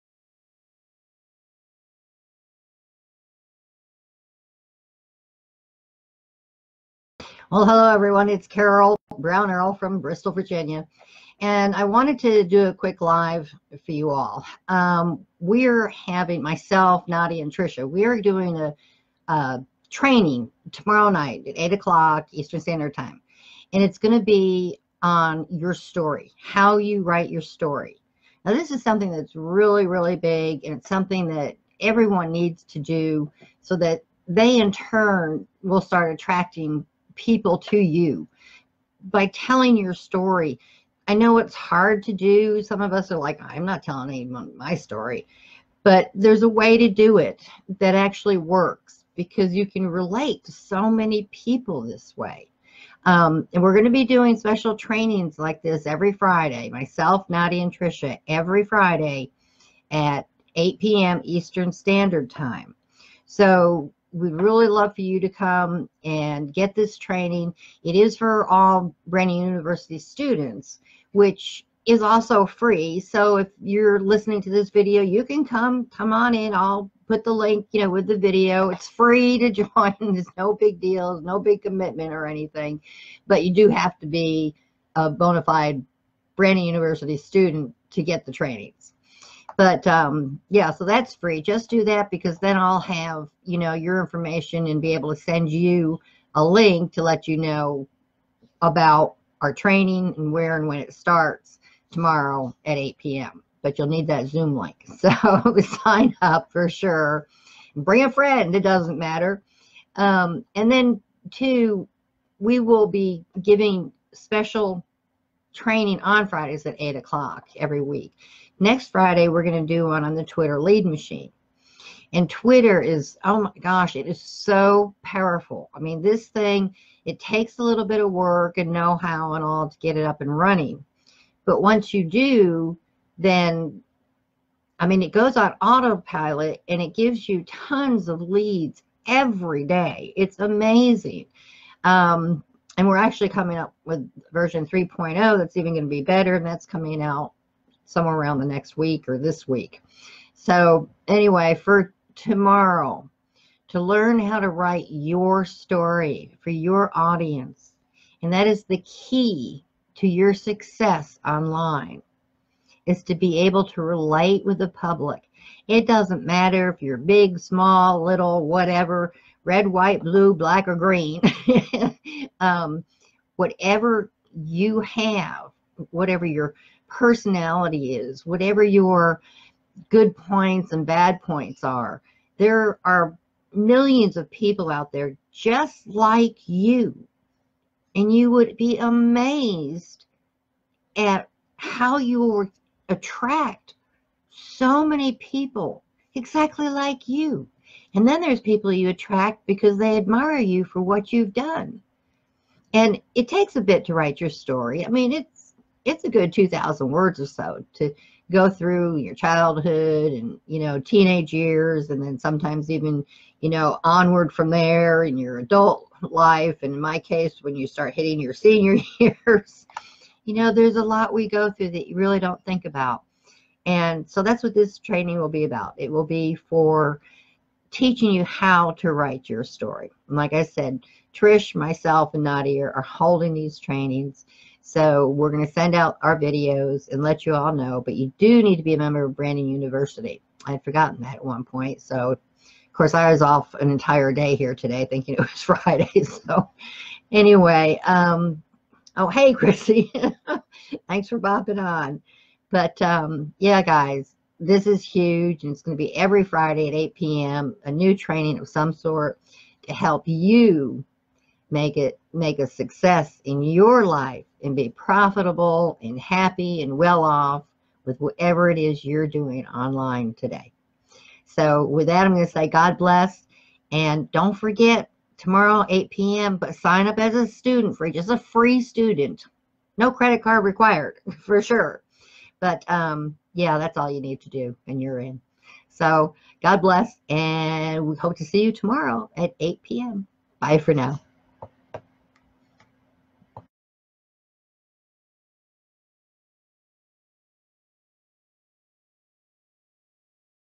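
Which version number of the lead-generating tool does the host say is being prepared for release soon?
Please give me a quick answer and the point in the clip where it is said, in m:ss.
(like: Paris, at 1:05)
3.0, at 2:24.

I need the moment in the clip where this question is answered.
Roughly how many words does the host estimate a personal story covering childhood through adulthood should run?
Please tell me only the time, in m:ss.
3:26.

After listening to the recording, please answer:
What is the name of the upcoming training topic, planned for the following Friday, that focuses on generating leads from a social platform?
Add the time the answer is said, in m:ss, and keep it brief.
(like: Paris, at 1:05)
Twitter lead machine, at 2:00.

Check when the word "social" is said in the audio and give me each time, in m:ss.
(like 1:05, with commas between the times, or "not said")
not said.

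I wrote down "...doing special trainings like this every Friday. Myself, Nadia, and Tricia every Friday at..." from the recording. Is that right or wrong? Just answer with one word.
right.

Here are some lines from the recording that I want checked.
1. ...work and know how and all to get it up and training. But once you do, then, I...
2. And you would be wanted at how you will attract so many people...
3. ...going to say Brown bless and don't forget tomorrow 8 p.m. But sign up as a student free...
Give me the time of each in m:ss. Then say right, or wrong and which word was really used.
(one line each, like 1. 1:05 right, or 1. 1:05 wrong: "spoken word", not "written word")
1. 2:08 wrong: "running", not "training"
2. 3:07 wrong: "amazed", not "wanted"
3. 4:32 wrong: "God", not "Brown".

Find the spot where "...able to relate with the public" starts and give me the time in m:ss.
2:43.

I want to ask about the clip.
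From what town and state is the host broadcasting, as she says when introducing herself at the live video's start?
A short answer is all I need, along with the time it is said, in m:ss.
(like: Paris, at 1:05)
Bristol, Virginia, at 0:09.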